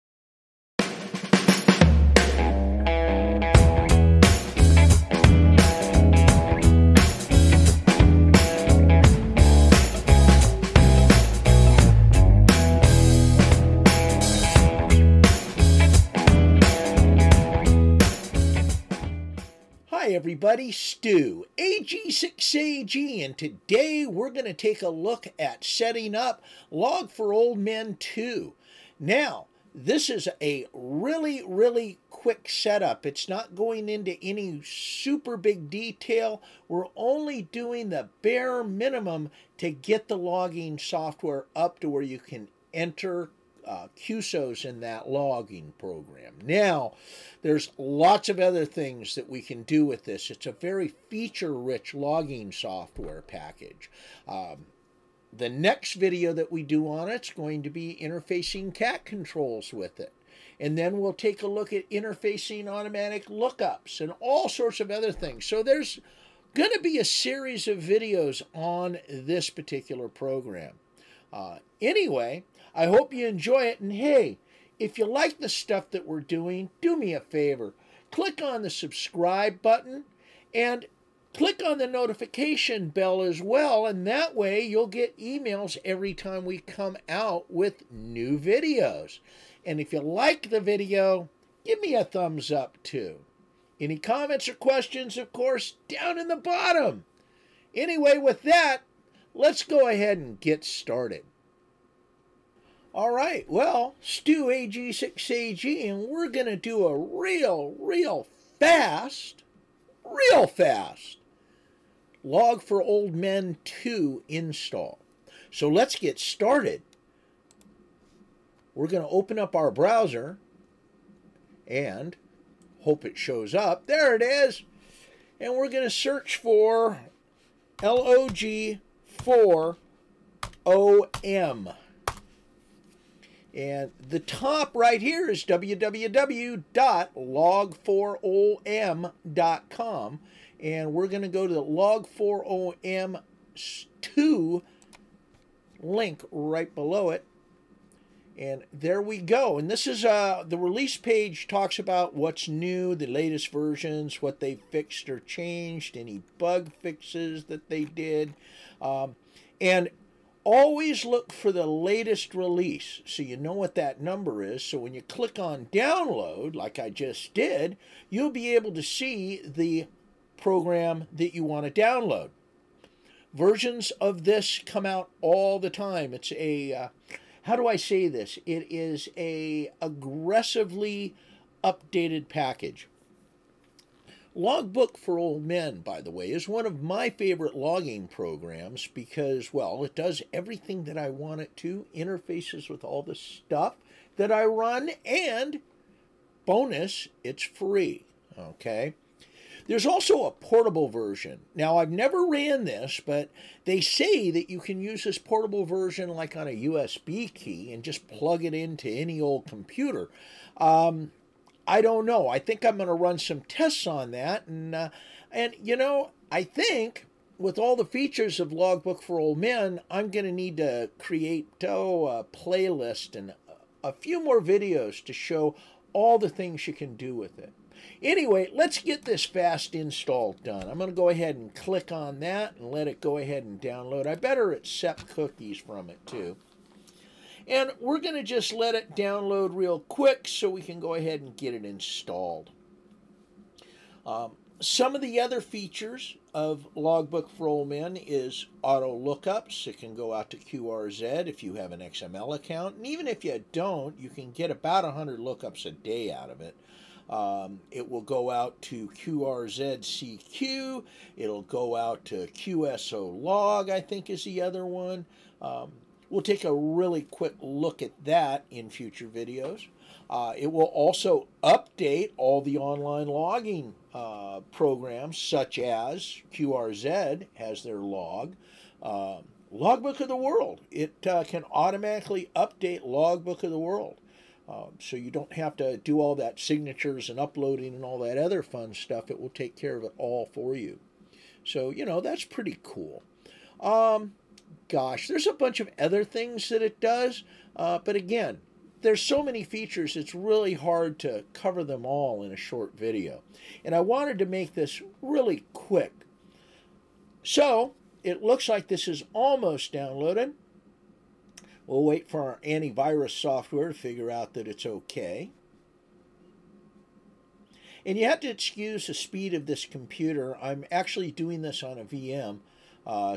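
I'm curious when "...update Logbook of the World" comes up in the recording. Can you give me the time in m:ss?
4:42.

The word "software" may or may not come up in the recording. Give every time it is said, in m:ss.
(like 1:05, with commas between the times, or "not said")
0:40, 0:52, 5:13.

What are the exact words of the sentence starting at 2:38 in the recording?
Um, and always look for the latest release so you know what that number is.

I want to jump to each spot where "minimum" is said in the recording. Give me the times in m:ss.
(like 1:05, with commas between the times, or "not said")
0:38.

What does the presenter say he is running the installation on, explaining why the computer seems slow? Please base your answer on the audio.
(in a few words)
a VM.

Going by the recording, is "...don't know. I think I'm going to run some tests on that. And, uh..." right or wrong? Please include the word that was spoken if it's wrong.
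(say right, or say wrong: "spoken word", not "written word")
right.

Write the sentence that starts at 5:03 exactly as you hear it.
And I wanted to make this really quick.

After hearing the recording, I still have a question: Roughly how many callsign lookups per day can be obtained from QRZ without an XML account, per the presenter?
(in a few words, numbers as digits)
100.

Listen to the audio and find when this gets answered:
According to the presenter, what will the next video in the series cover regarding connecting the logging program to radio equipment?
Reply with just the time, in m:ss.
0:58.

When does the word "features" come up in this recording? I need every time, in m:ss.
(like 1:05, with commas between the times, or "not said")
0:51, 3:37, 4:05, 4:59.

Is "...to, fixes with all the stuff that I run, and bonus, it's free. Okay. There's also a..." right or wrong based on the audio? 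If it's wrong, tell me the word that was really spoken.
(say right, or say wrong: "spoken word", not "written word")
wrong: "interfaces", not "fixes".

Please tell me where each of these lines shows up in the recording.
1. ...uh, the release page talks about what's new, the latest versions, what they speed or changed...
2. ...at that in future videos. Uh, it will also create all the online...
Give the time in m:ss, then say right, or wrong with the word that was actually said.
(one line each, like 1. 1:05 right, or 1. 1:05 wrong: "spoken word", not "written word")
1. 2:30 wrong: "fixed", not "speed"
2. 4:27 wrong: "update", not "create".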